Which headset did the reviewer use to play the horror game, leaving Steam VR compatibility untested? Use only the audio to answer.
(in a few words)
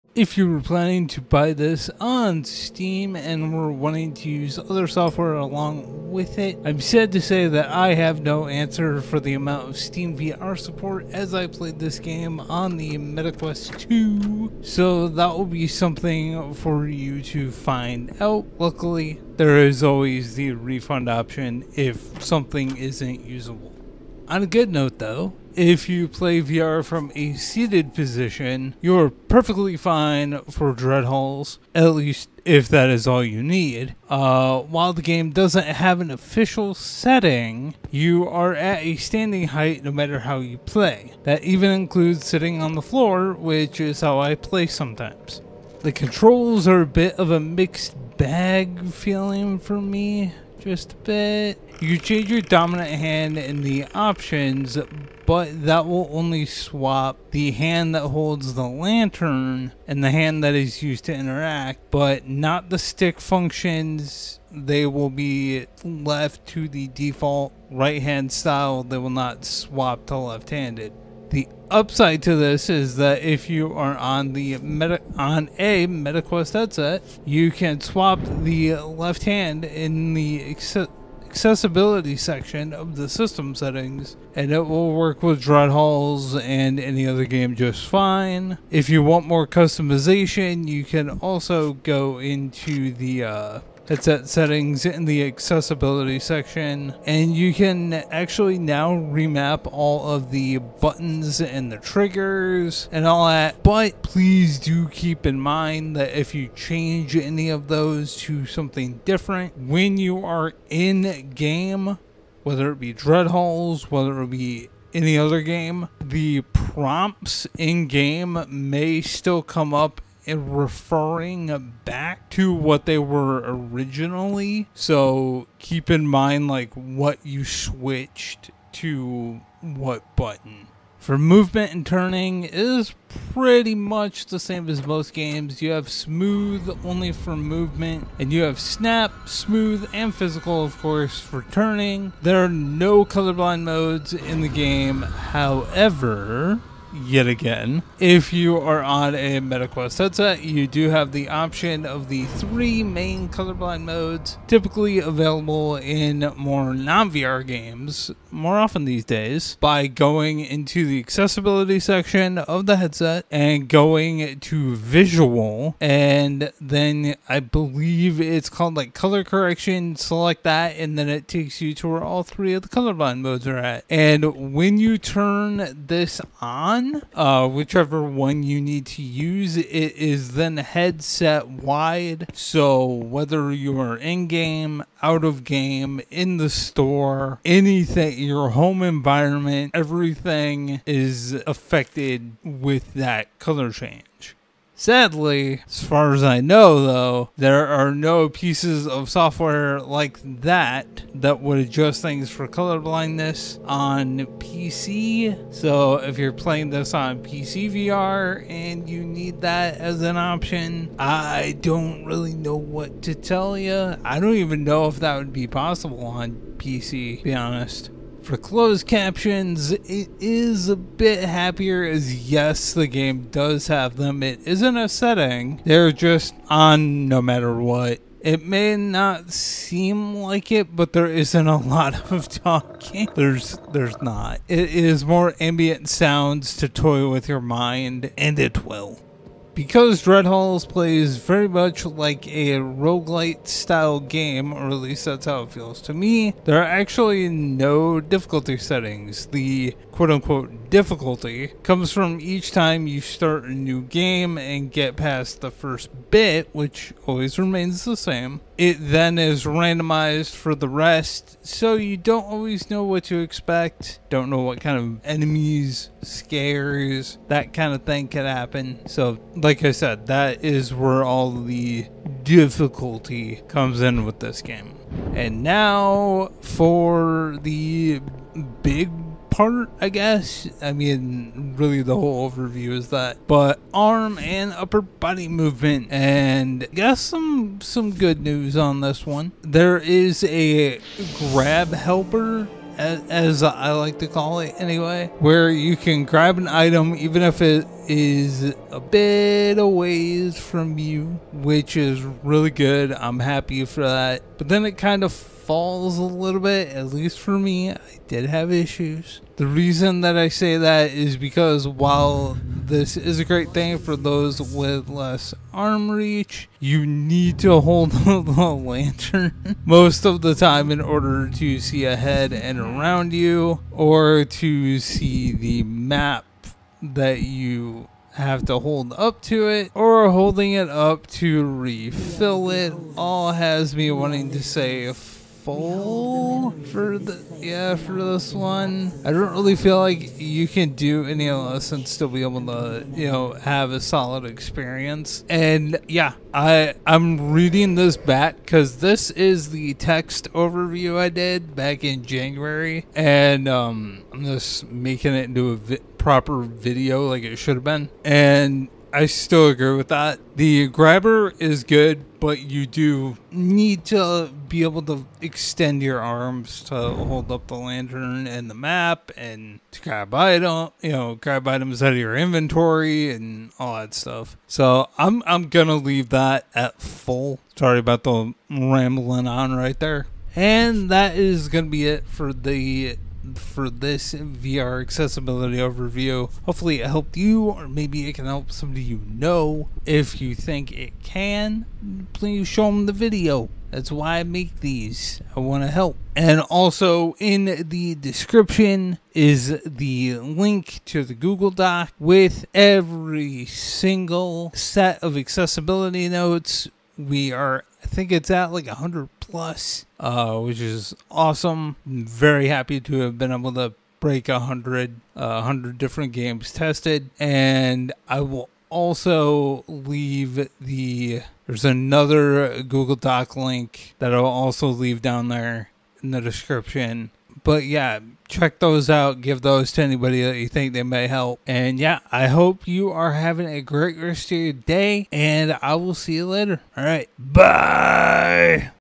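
Meta Quest 2.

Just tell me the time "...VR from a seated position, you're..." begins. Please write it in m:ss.
0:26.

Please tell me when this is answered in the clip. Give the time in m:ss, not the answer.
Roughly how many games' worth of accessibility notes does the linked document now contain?
6:48.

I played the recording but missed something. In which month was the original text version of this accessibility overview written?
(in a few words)
January.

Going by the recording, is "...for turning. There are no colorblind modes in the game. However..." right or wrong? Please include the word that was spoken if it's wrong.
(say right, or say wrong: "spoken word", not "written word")
right.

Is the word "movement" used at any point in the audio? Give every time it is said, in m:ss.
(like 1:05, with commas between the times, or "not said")
2:11, 2:17, 4:45.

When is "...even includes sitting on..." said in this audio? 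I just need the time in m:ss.
0:41.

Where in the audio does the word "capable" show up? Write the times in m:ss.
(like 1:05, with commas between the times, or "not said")
not said.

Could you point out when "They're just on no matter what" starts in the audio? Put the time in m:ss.
3:45.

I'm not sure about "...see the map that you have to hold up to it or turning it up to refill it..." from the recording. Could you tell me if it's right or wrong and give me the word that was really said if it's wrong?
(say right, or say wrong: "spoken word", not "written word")
wrong: "holding", not "turning".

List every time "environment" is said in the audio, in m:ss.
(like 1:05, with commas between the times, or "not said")
3:08.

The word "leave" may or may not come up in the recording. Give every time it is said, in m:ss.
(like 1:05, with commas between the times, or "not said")
6:15, 6:59, 7:04.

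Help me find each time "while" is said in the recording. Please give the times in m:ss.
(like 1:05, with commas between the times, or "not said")
0:34, 5:11.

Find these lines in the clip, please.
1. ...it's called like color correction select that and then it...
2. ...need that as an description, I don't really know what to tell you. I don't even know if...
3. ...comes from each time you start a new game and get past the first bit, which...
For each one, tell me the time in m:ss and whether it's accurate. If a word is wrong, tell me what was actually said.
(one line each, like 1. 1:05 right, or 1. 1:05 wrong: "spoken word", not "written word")
1. 2:48 right
2. 3:29 wrong: "option", not "description"
3. 4:11 right.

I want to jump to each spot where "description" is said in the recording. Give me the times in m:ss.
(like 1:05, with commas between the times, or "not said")
6:37, 7:06.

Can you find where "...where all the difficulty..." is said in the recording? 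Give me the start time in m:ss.
4:30.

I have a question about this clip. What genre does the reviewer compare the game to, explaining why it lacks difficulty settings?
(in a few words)
Roguelite.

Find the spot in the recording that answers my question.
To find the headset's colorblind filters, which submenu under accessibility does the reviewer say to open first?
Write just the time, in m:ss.
2:44.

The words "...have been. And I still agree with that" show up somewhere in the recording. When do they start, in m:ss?
5:57.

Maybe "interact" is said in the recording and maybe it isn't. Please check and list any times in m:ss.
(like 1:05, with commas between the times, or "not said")
1:01.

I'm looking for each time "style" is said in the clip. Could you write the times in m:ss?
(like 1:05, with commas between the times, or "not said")
1:08, 4:03.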